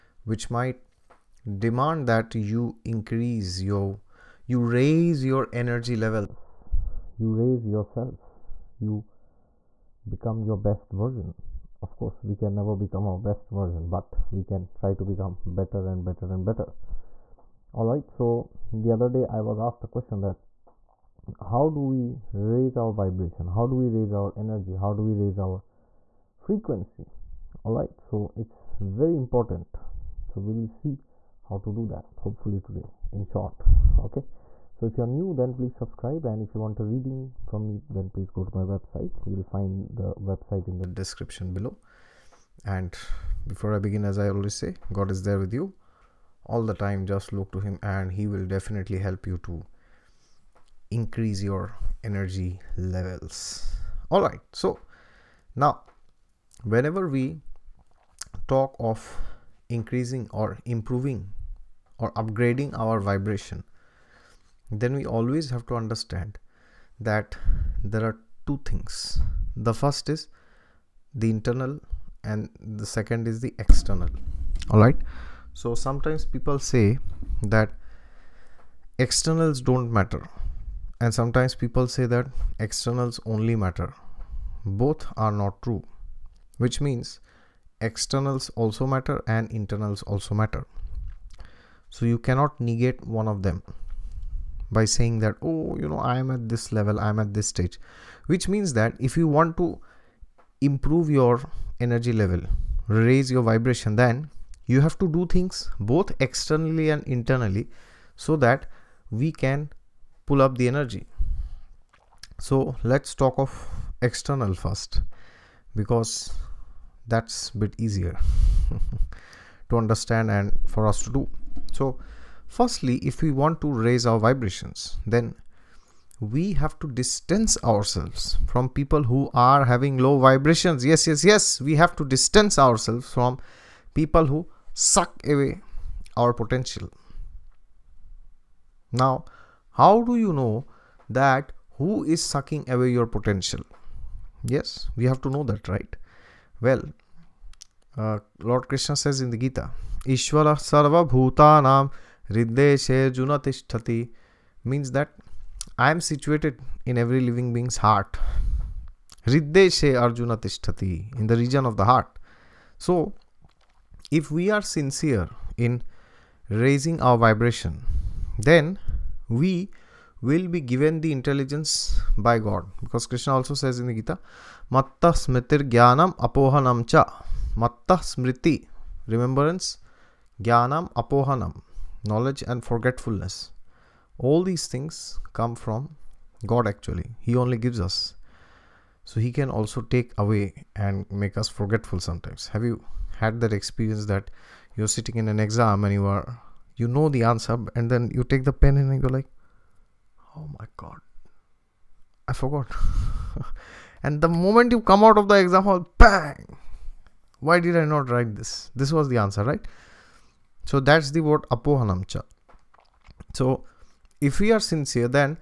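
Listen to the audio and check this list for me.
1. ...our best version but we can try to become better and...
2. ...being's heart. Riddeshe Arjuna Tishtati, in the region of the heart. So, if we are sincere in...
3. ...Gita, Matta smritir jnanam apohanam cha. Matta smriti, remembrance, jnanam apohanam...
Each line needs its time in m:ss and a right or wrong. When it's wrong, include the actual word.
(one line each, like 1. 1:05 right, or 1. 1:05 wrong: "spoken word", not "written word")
1. 0:13 right
2. 2:37 right
3. 2:53 right.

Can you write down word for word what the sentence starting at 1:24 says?
Both are not true, which means externals also matter and internals also matter.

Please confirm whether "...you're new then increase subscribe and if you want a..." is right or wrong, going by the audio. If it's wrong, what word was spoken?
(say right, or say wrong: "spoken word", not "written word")
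wrong: "please", not "increase".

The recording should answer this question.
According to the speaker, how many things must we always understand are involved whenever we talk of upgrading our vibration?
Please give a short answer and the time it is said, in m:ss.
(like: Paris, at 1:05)
2, at 1:08.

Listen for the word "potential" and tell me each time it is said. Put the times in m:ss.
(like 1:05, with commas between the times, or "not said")
2:16, 2:23.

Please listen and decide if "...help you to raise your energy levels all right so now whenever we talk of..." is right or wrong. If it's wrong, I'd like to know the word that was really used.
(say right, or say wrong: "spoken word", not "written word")
wrong: "increase", not "raise".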